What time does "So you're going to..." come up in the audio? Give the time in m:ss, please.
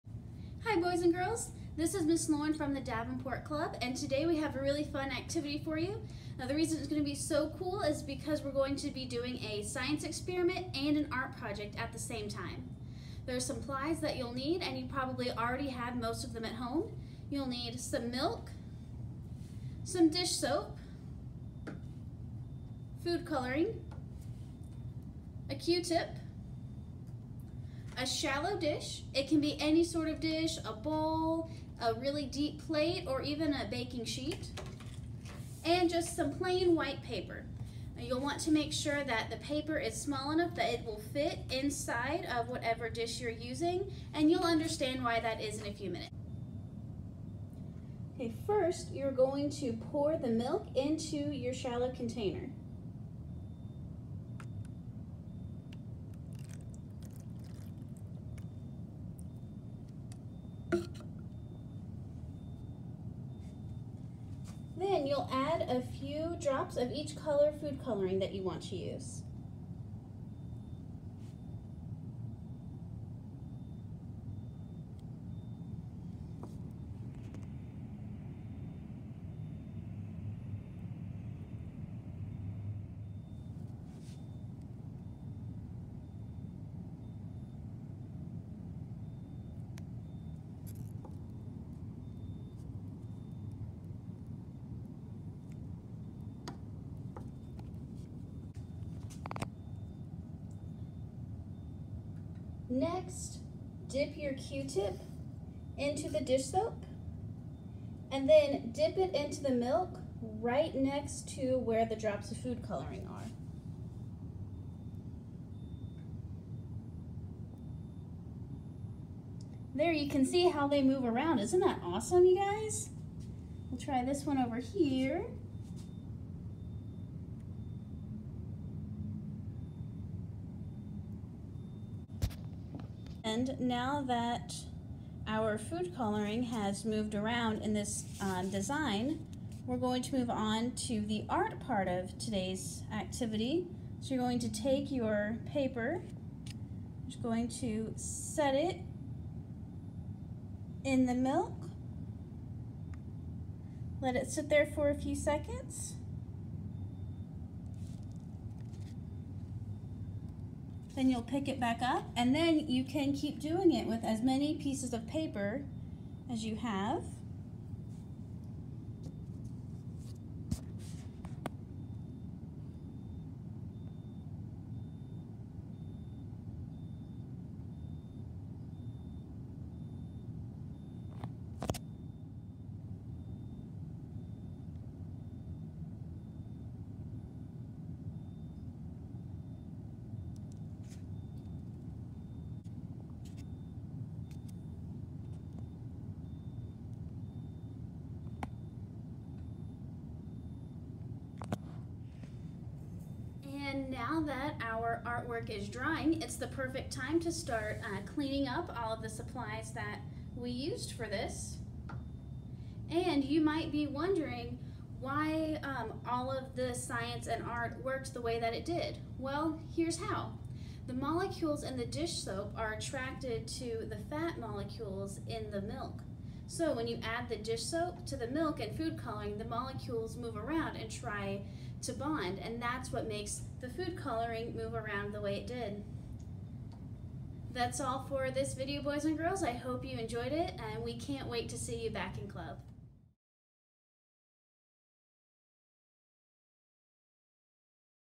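2:24.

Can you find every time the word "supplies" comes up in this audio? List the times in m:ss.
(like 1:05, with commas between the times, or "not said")
0:13, 3:29.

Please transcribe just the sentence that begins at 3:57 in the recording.
That's all for this video, boys and girls.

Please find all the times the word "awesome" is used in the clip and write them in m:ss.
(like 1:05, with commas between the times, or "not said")
2:01.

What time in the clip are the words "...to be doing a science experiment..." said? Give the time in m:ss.
0:08.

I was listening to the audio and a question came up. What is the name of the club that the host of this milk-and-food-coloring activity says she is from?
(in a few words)
Davenport Club.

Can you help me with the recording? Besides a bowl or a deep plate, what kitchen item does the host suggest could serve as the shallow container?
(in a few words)
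baking sheet.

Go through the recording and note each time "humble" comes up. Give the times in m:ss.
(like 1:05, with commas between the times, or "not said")
not said.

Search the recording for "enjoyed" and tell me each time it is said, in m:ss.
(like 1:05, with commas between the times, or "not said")
3:59.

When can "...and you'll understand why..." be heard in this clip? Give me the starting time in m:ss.
0:44.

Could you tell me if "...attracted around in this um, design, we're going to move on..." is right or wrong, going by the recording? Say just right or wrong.
wrong.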